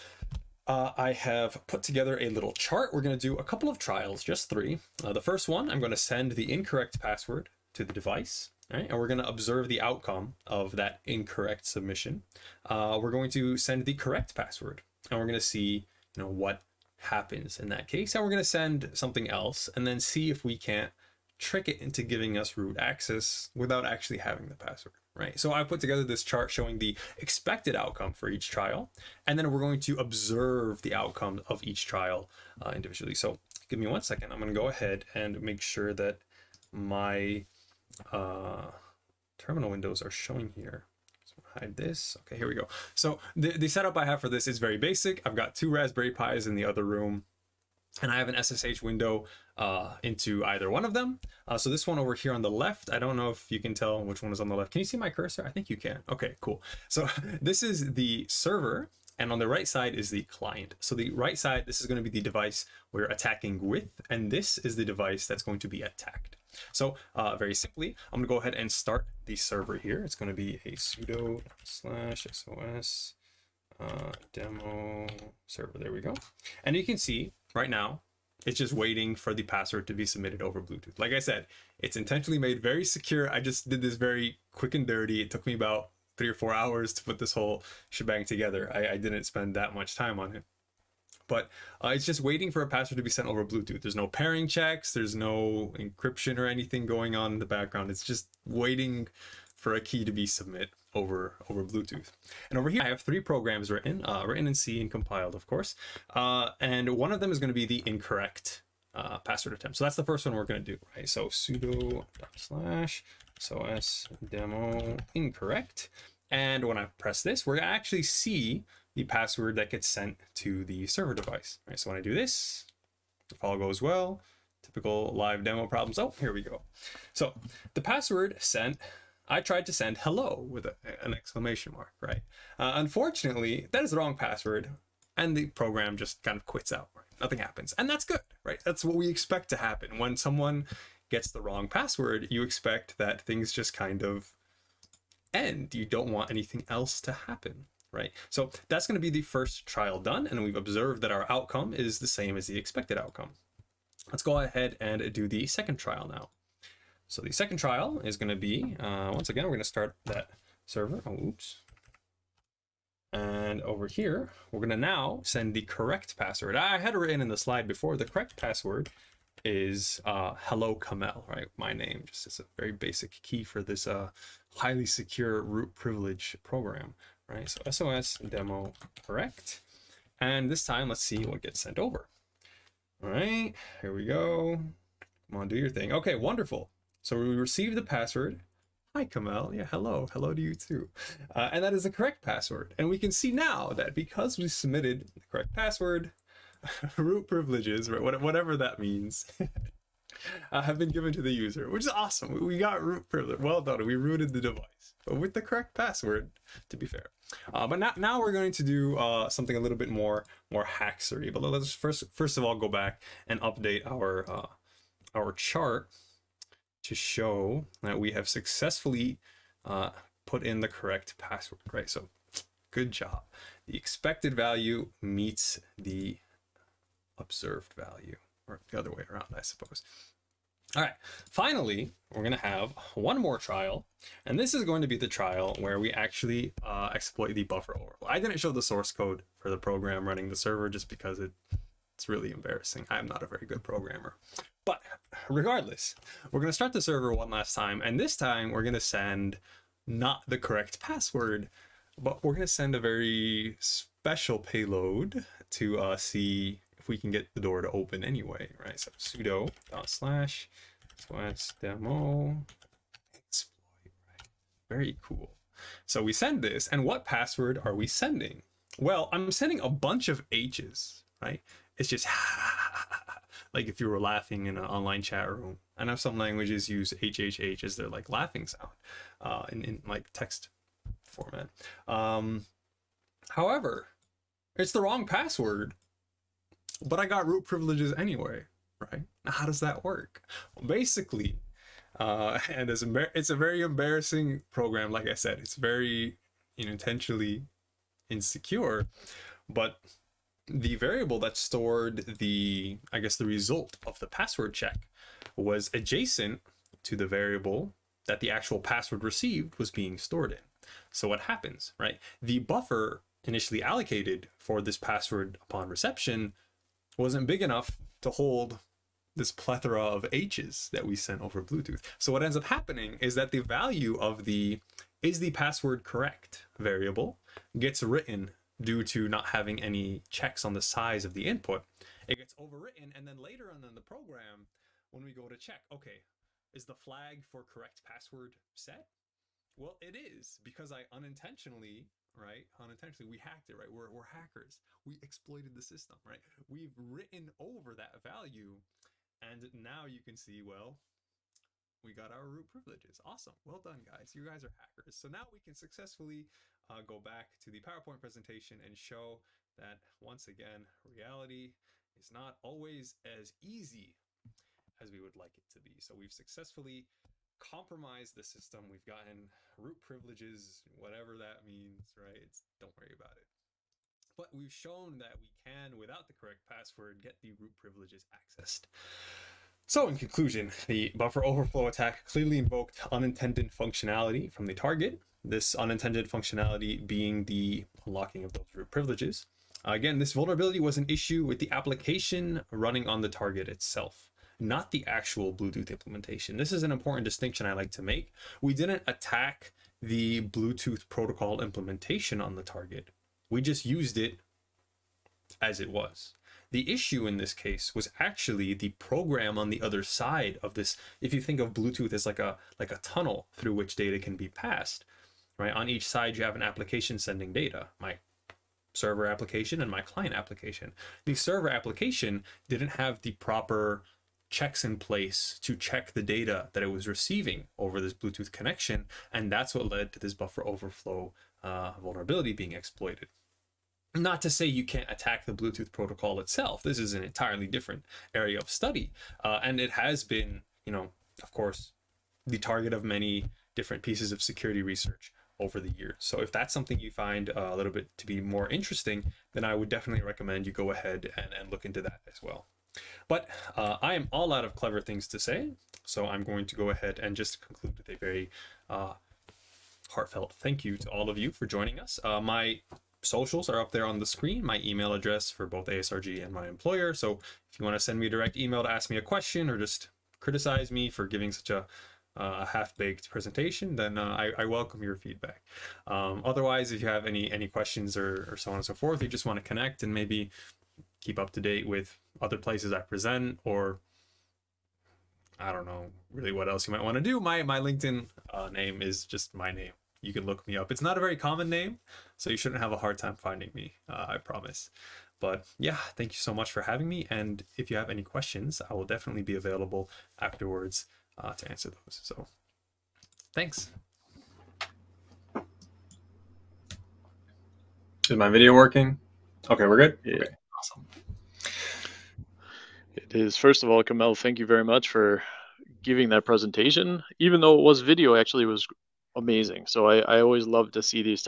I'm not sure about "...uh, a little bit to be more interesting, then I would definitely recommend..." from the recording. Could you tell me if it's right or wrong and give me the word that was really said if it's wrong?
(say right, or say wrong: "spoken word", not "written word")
right.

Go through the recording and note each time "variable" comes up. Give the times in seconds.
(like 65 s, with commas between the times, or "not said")
300 s, 307 s, 326 s.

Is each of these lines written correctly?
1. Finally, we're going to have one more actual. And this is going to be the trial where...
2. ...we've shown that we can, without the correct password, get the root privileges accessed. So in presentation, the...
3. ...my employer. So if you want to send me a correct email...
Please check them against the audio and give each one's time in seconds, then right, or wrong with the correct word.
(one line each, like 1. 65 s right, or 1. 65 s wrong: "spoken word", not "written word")
1. 231 s wrong: "trial", not "actual"
2. 374 s wrong: "conclusion", not "presentation"
3. 466 s wrong: "direct", not "correct".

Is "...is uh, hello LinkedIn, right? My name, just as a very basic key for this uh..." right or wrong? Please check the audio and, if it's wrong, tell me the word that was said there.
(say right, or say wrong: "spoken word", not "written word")
wrong: "Kamel", not "LinkedIn".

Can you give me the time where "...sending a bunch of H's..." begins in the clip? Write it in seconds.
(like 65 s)
269 s.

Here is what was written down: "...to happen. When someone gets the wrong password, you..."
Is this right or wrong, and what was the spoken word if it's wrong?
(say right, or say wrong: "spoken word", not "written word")
right.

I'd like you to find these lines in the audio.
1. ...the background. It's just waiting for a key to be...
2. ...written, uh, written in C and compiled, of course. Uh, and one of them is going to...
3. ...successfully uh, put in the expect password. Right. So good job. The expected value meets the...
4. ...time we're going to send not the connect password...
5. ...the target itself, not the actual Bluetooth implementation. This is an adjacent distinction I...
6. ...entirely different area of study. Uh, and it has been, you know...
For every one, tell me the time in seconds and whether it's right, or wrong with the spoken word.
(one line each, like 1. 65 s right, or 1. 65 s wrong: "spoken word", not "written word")
1. 97 s right
2. 103 s right
3. 218 s wrong: "correct", not "expect"
4. 248 s wrong: "correct", not "connect"
5. 393 s wrong: "important", not "adjacent"
6. 437 s right.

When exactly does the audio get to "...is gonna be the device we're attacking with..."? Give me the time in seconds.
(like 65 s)
61 s.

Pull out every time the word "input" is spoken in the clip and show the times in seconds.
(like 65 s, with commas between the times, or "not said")
331 s.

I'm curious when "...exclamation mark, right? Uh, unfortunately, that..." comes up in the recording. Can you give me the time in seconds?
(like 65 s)
131 s.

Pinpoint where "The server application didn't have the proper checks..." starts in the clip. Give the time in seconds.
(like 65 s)
421 s.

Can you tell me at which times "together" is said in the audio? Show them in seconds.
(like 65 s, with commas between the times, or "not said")
1 s, 25 s, 88 s.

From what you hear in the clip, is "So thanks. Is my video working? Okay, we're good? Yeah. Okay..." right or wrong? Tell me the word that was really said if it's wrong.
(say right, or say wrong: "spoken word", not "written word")
right.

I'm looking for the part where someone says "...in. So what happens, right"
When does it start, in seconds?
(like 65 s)
310 s.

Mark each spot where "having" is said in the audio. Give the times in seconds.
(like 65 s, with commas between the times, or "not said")
24 s, 329 s, 496 s.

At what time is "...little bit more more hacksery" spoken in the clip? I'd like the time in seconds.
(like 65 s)
209 s.